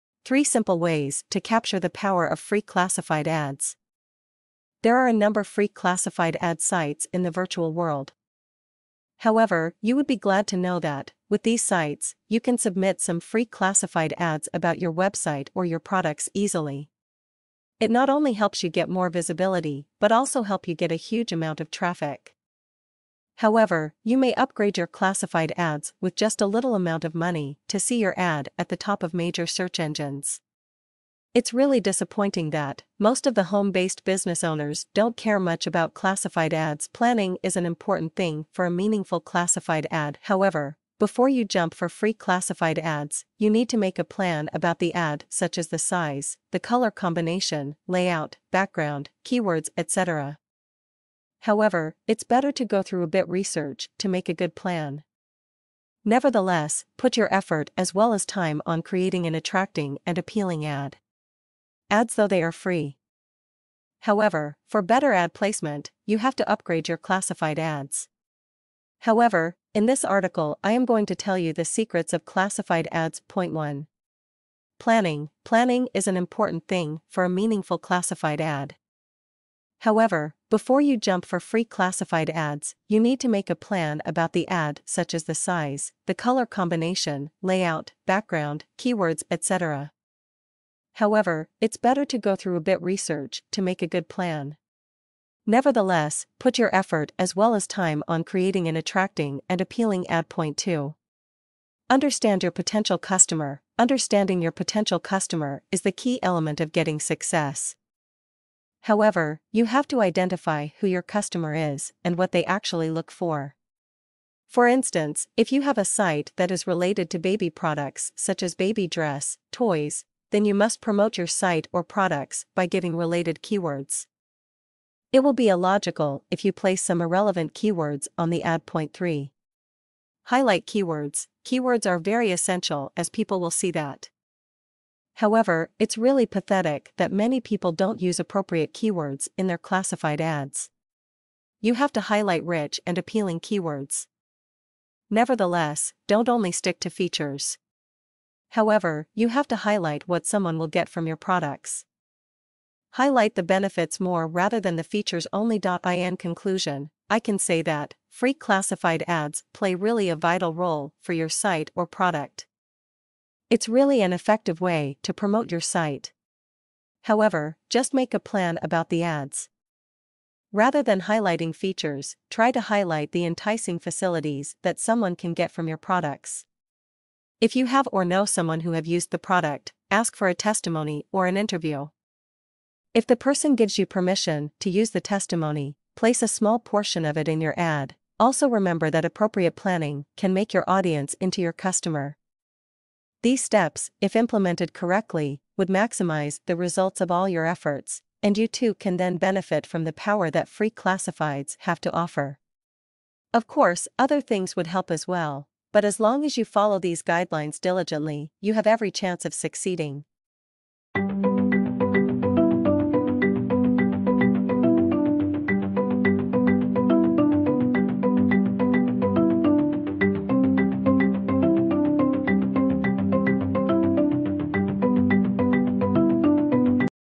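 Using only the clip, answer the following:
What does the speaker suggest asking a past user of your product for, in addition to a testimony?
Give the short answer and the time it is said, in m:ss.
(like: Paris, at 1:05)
an interview, at 3:01.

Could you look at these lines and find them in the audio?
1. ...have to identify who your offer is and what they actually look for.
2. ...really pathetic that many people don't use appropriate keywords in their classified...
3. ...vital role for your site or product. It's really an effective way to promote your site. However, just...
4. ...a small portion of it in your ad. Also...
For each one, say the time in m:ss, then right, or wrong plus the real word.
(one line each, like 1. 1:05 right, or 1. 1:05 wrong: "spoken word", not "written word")
1. 1:49 wrong: "customer", not "offer"
2. 2:15 right
3. 2:40 right
4. 3:06 right.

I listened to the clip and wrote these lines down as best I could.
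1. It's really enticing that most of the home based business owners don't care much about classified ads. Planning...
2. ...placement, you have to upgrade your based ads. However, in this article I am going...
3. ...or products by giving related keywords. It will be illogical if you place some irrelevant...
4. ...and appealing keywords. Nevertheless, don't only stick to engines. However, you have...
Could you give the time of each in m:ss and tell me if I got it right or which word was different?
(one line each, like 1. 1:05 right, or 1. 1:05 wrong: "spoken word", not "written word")
1. 0:31 wrong: "disappointing", not "enticing"
2. 1:05 wrong: "classified", not "based"
3. 2:01 right
4. 2:22 wrong: "features", not "engines".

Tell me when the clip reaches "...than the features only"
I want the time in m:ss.
2:34.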